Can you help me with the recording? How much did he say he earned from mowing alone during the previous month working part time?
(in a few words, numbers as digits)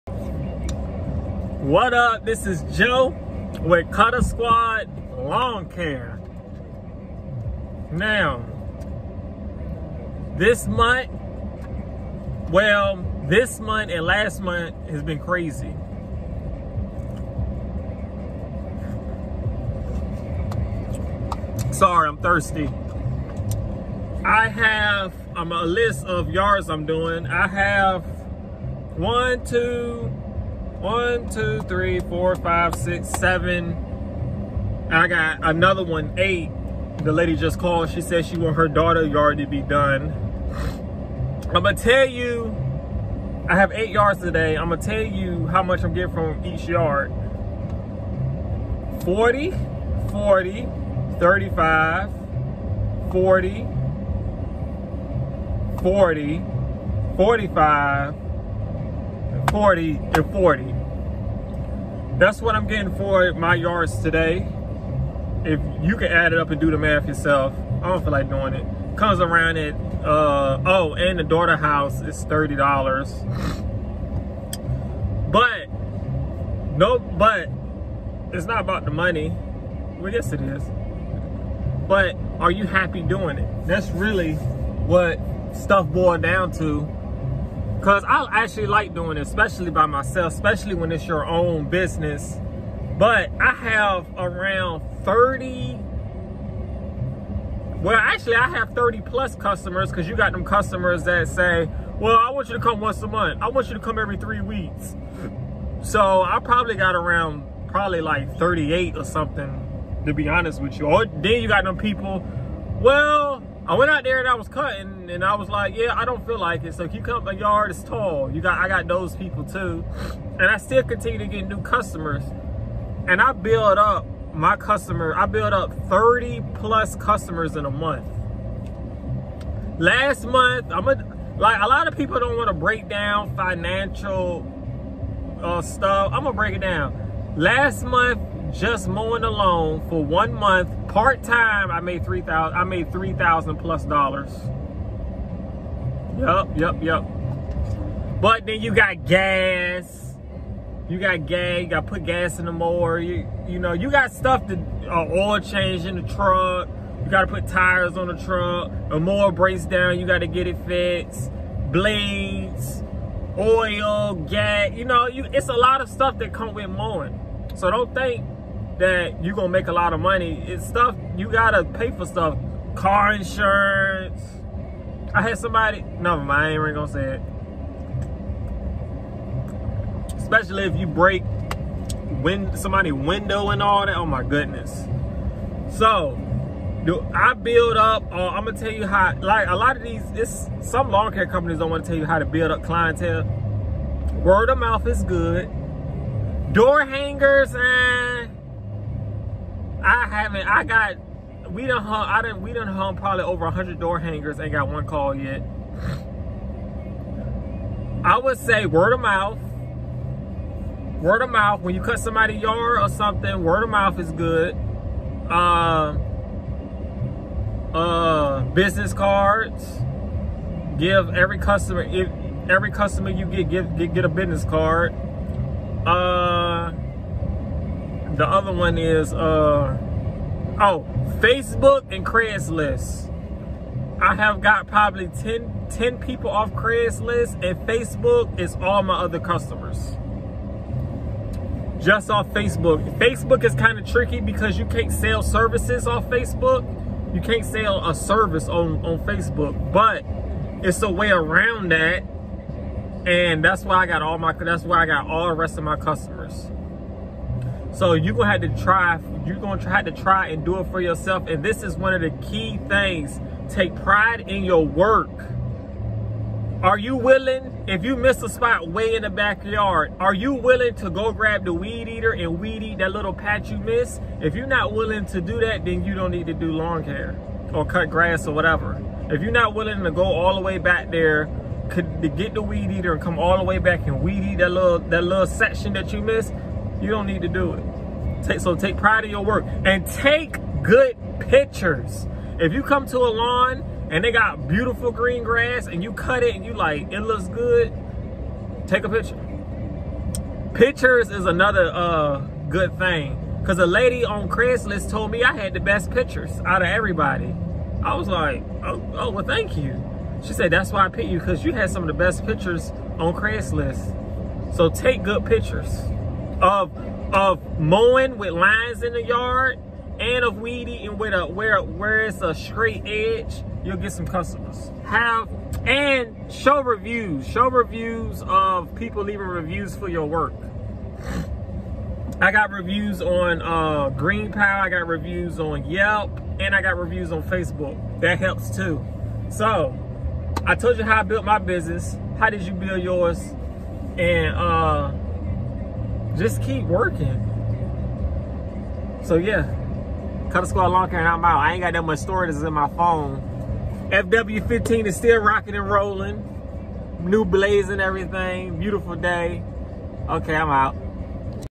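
3000 dollars.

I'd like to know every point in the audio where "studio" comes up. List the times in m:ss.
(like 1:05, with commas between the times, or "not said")
not said.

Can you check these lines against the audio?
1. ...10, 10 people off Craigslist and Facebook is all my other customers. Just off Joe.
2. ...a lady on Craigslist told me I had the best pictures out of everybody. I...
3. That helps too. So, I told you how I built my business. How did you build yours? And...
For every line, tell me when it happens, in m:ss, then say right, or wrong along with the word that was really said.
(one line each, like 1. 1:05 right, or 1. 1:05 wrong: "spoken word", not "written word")
1. 3:55 wrong: "Facebook", not "Joe"
2. 5:03 right
3. 5:38 right.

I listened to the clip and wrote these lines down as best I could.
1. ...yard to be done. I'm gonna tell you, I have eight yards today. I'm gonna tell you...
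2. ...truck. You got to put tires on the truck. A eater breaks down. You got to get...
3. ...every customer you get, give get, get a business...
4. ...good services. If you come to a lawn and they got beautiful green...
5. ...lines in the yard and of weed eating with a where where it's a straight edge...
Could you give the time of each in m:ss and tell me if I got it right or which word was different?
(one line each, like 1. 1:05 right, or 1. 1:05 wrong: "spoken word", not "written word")
1. 0:39 right
2. 2:36 wrong: "mower", not "eater"
3. 3:42 right
4. 4:50 wrong: "pictures", not "services"
5. 5:18 right.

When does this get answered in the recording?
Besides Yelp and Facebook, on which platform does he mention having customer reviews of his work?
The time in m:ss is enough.
5:33.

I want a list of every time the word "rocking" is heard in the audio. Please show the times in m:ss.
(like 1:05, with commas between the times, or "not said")
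5:55.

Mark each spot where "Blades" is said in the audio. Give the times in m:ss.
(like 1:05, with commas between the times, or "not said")
2:41.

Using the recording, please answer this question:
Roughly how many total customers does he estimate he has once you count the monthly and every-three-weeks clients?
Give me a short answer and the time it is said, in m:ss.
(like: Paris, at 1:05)
38, at 1:48.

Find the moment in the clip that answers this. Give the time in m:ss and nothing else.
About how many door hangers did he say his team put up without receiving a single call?
3:23.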